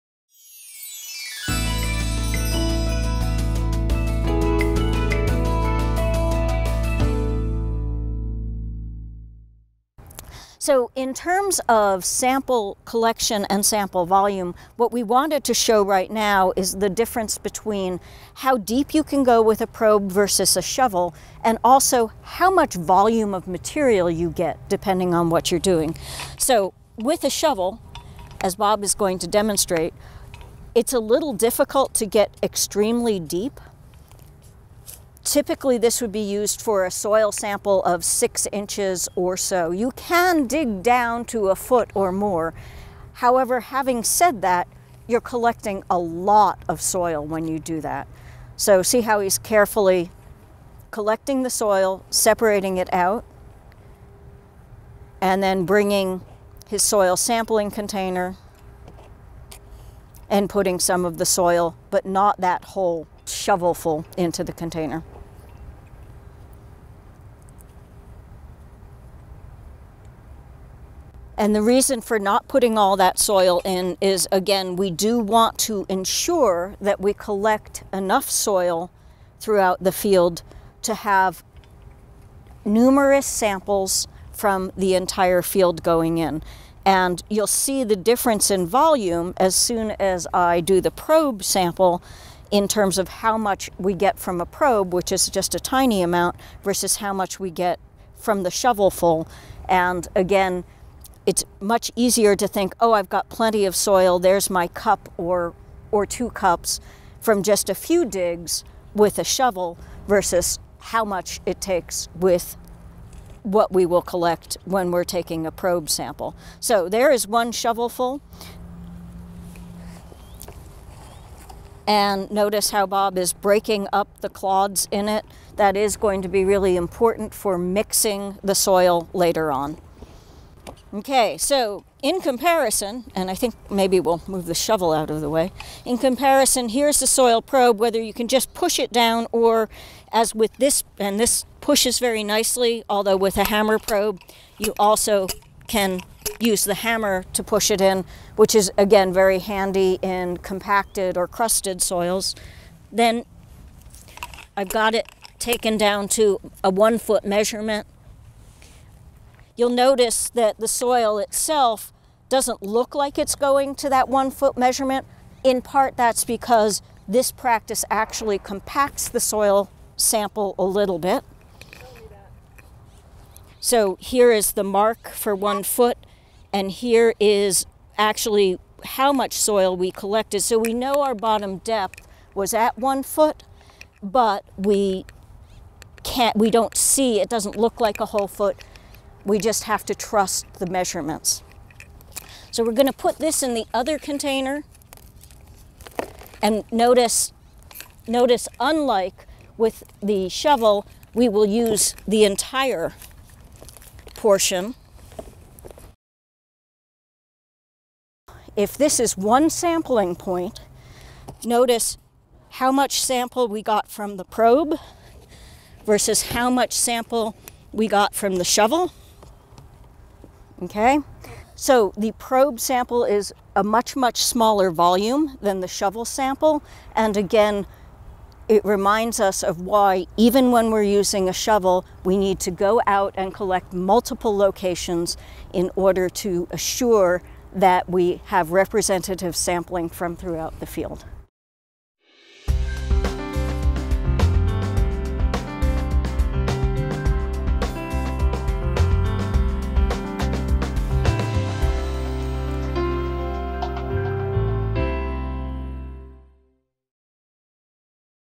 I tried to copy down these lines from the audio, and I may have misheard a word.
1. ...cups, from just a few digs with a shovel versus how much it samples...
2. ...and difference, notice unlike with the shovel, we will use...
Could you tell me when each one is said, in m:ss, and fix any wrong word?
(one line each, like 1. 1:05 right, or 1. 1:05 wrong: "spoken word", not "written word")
1. 1:46 wrong: "takes", not "samples"
2. 3:16 wrong: "notice", not "difference".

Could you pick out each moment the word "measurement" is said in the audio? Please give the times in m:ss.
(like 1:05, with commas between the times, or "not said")
2:37, 2:44, 3:10.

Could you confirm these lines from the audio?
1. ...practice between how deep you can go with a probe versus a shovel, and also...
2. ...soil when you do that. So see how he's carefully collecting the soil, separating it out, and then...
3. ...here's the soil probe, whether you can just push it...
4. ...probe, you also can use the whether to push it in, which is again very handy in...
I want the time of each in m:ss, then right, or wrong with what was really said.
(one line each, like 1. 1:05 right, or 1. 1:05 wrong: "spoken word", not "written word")
1. 0:16 wrong: "difference", not "practice"
2. 0:46 right
3. 2:16 right
4. 2:23 wrong: "hammer", not "whether".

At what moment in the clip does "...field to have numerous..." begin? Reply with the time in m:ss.
1:19.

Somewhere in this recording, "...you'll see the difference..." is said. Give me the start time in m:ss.
1:27.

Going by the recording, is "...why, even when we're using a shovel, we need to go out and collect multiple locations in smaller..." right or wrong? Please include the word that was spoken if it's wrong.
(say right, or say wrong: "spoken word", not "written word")
wrong: "order", not "smaller".